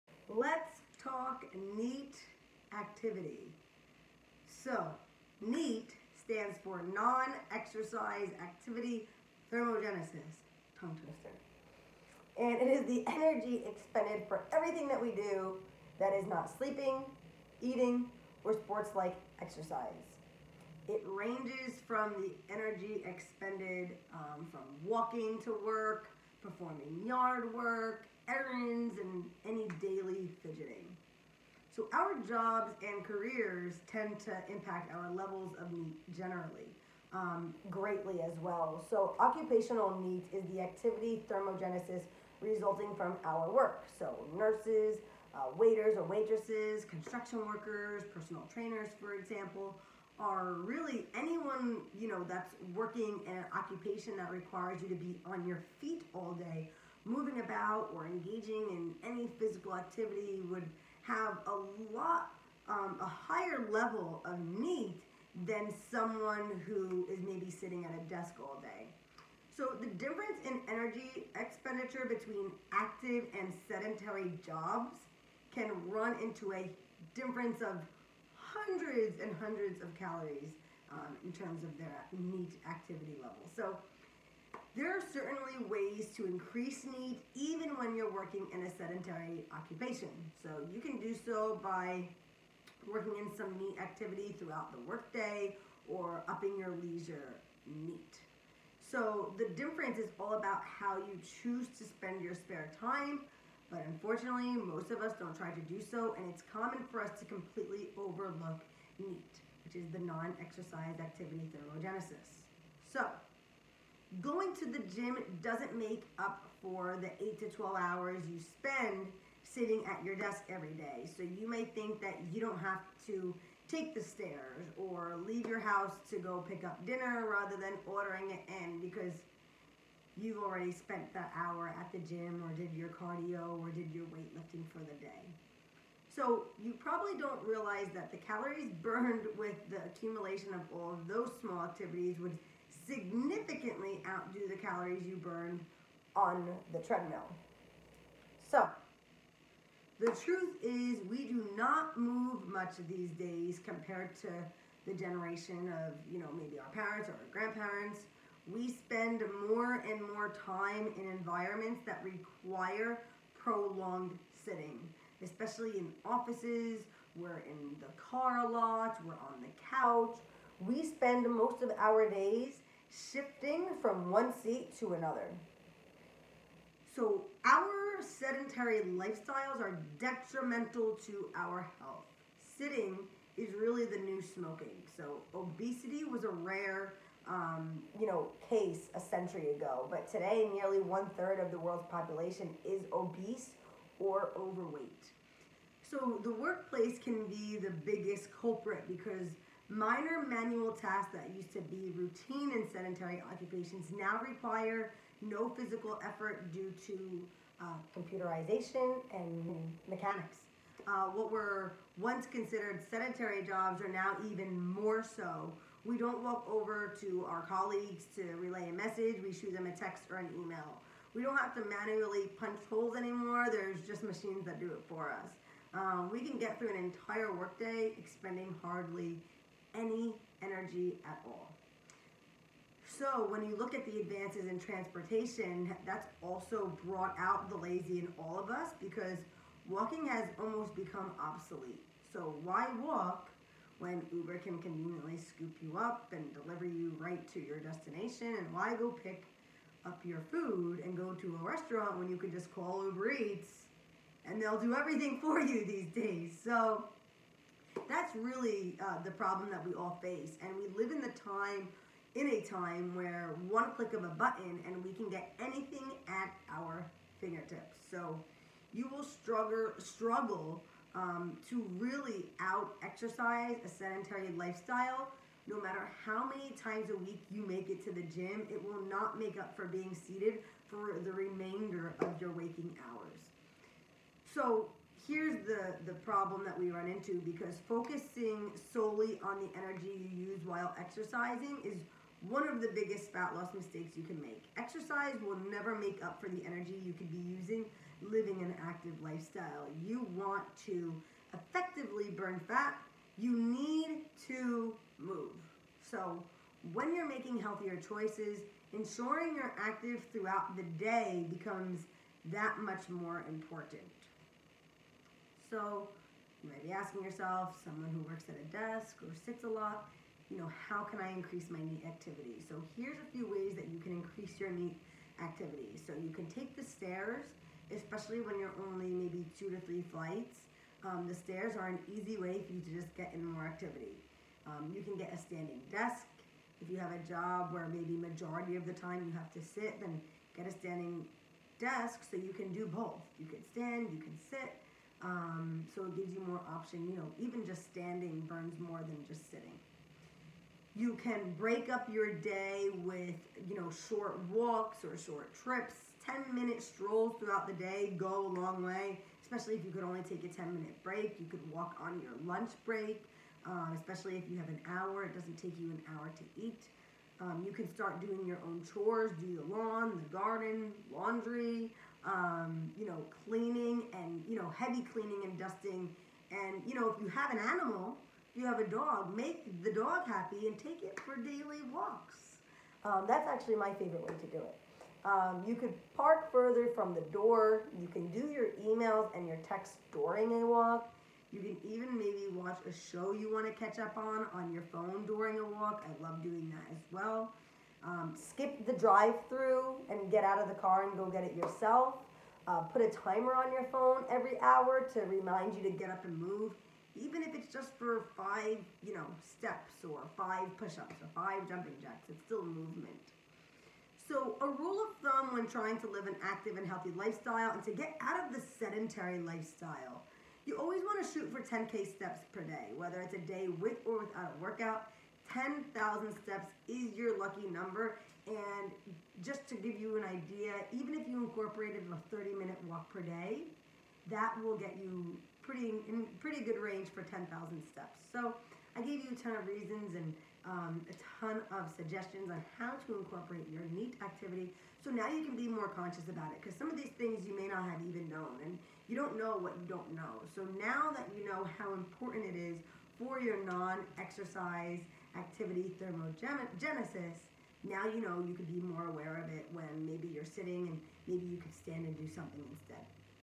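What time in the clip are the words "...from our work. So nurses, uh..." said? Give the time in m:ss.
0:42.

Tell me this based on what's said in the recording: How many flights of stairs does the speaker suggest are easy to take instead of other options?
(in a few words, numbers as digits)
2 to 3.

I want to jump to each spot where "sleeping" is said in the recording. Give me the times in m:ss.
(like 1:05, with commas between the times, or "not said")
0:16.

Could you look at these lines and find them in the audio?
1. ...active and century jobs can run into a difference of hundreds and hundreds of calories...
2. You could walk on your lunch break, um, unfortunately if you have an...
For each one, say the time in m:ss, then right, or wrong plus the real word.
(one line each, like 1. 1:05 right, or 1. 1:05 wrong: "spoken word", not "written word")
1. 1:12 wrong: "sedentary", not "century"
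2. 6:01 wrong: "especially", not "unfortunately".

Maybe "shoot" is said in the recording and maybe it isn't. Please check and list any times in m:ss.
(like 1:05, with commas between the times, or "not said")
3:39, 7:01.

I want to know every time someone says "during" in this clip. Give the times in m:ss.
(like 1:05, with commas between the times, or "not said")
6:29, 6:35.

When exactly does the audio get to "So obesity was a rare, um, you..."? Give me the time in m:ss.
3:04.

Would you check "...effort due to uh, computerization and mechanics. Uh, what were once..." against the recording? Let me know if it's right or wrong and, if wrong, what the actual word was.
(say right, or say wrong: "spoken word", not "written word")
right.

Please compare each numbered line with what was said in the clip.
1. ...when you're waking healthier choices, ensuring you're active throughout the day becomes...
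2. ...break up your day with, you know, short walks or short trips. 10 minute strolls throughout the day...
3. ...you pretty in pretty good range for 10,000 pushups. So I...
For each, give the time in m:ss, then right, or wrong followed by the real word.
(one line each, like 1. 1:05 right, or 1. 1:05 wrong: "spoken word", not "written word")
1. 5:06 wrong: "making", not "waking"
2. 5:51 right
3. 7:14 wrong: "steps", not "pushups".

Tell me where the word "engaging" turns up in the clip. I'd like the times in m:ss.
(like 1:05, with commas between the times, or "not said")
0:58.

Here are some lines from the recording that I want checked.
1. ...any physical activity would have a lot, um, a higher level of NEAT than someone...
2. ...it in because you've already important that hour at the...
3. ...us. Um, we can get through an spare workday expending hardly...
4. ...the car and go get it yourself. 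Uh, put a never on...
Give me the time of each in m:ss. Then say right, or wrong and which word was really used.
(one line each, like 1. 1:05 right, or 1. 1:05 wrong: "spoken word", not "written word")
1. 0:59 right
2. 2:08 wrong: "spent", not "important"
3. 3:45 wrong: "entire", not "spare"
4. 6:40 wrong: "timer", not "never".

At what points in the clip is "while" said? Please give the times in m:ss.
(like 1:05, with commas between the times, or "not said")
4:50.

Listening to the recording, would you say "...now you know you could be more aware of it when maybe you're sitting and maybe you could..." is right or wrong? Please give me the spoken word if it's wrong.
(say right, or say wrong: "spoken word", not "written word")
right.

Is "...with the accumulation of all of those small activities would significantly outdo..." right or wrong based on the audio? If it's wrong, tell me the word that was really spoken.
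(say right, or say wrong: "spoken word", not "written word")
right.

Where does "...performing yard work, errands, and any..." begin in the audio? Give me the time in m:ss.
0:26.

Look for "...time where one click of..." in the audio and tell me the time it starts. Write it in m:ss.
4:22.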